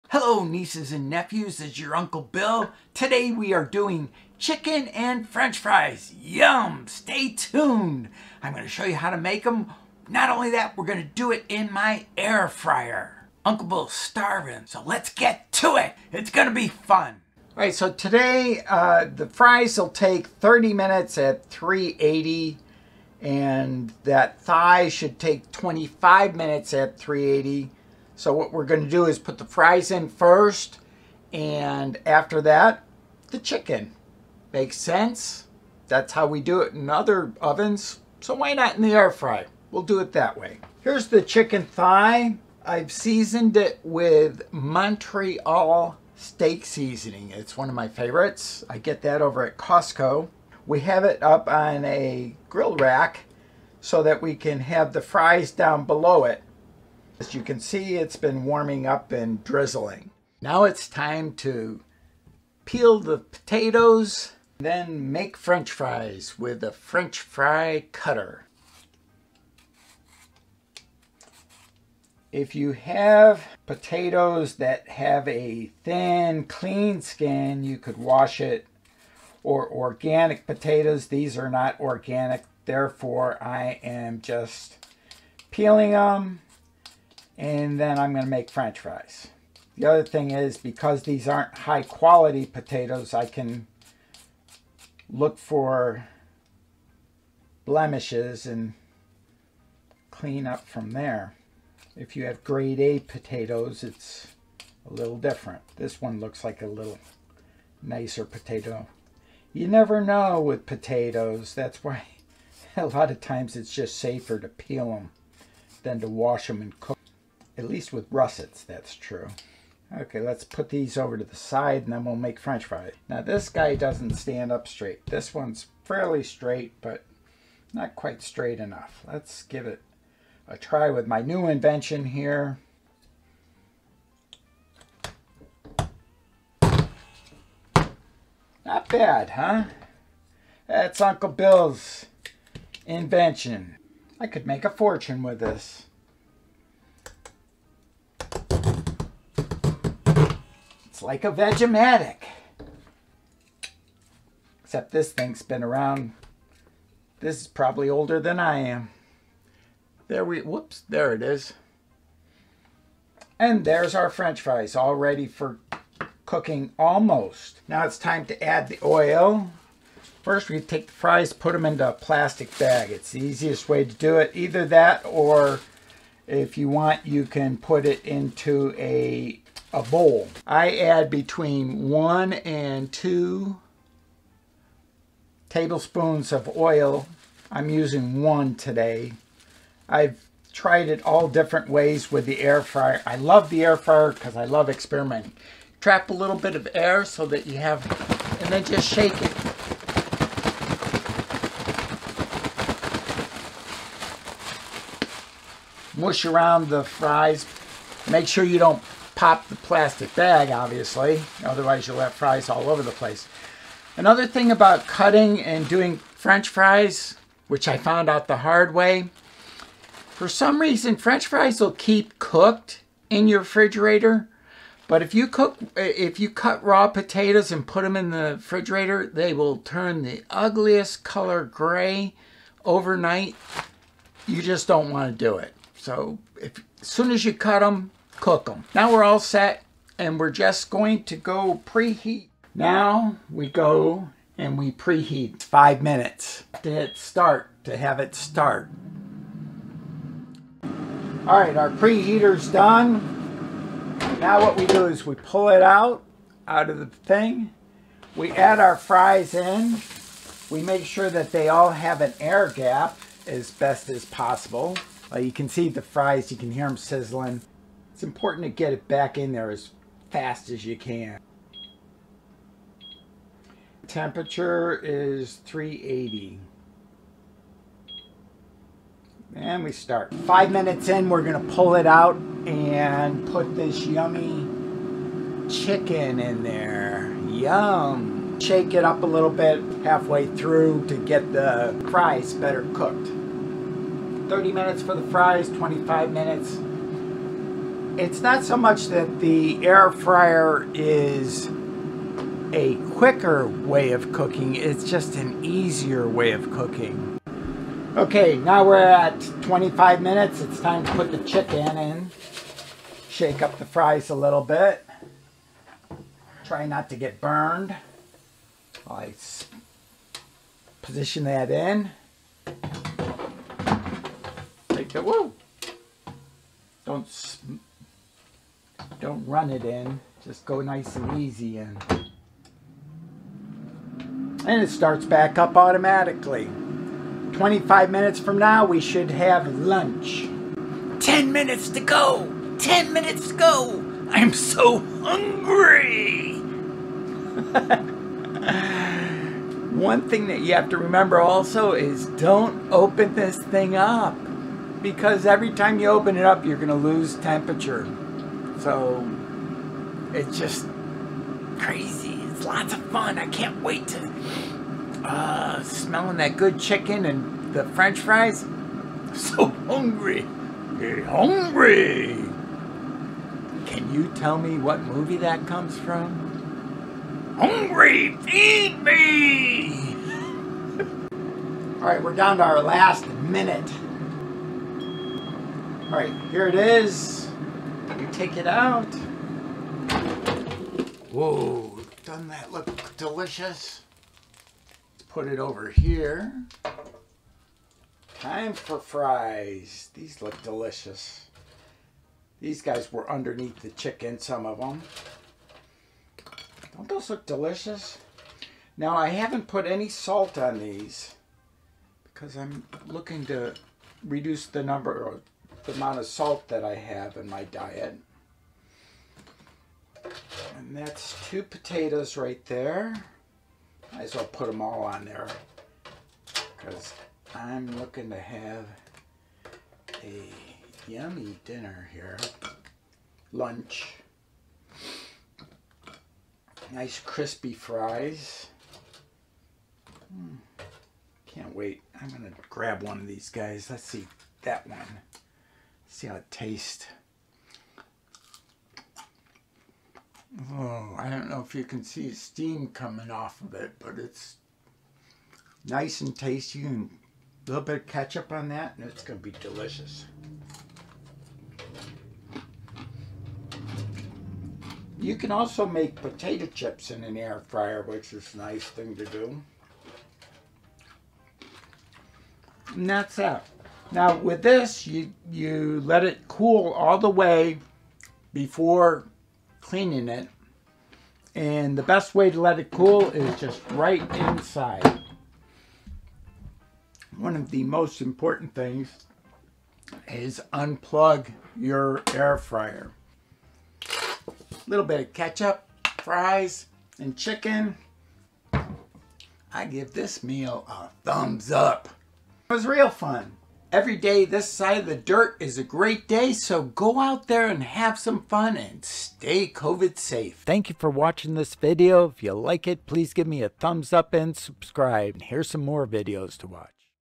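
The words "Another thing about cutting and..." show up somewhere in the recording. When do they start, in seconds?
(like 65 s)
213 s.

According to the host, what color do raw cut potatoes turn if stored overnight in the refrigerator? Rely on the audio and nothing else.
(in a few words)
gray.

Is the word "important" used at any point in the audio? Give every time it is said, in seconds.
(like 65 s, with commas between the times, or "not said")
268 s, 488 s.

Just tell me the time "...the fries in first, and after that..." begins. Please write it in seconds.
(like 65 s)
29 s.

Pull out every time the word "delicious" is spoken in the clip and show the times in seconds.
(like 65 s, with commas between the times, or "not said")
392 s, 400 s, 407 s, 459 s.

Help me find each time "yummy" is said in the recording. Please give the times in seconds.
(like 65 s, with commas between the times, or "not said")
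283 s, 430 s.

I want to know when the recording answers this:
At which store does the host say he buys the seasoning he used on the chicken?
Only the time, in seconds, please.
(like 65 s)
49 s.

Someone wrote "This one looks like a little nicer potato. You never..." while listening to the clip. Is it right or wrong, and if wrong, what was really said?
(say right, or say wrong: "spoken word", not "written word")
right.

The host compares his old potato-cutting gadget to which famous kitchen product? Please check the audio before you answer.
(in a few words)
Vegematic.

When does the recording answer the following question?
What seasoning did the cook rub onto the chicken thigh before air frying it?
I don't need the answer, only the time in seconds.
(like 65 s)
44 s.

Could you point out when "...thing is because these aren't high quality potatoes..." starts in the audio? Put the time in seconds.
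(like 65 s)
90 s.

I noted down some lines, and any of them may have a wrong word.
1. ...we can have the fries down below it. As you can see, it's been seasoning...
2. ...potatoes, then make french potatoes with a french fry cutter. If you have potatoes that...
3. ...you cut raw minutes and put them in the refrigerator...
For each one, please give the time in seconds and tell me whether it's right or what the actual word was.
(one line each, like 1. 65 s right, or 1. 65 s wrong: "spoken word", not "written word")
1. 54 s wrong: "warming", not "seasoning"
2. 63 s wrong: "fries", not "potatoes"
3. 226 s wrong: "potatoes", not "minutes".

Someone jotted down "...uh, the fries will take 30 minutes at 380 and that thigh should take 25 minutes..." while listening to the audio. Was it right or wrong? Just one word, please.
right.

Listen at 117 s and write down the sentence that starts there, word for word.
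At least with russets, that's true.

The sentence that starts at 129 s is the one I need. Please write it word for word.
Let's give it a try with my new invention here.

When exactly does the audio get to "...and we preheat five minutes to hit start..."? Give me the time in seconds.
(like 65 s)
244 s.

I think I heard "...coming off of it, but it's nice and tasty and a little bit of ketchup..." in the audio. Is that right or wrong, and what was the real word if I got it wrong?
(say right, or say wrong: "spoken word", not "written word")
right.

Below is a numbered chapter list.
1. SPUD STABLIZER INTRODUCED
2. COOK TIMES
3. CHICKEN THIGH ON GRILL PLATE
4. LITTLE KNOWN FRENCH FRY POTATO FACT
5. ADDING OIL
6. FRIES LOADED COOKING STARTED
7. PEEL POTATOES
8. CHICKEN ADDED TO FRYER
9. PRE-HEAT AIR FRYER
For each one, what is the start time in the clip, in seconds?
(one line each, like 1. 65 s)
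1. 132 s
2. 17 s
3. 42 s
4. 222 s
5. 172 s
6. 257 s
7. 61 s
8. 312 s
9. 242 s.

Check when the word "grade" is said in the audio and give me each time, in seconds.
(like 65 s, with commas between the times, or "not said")
102 s.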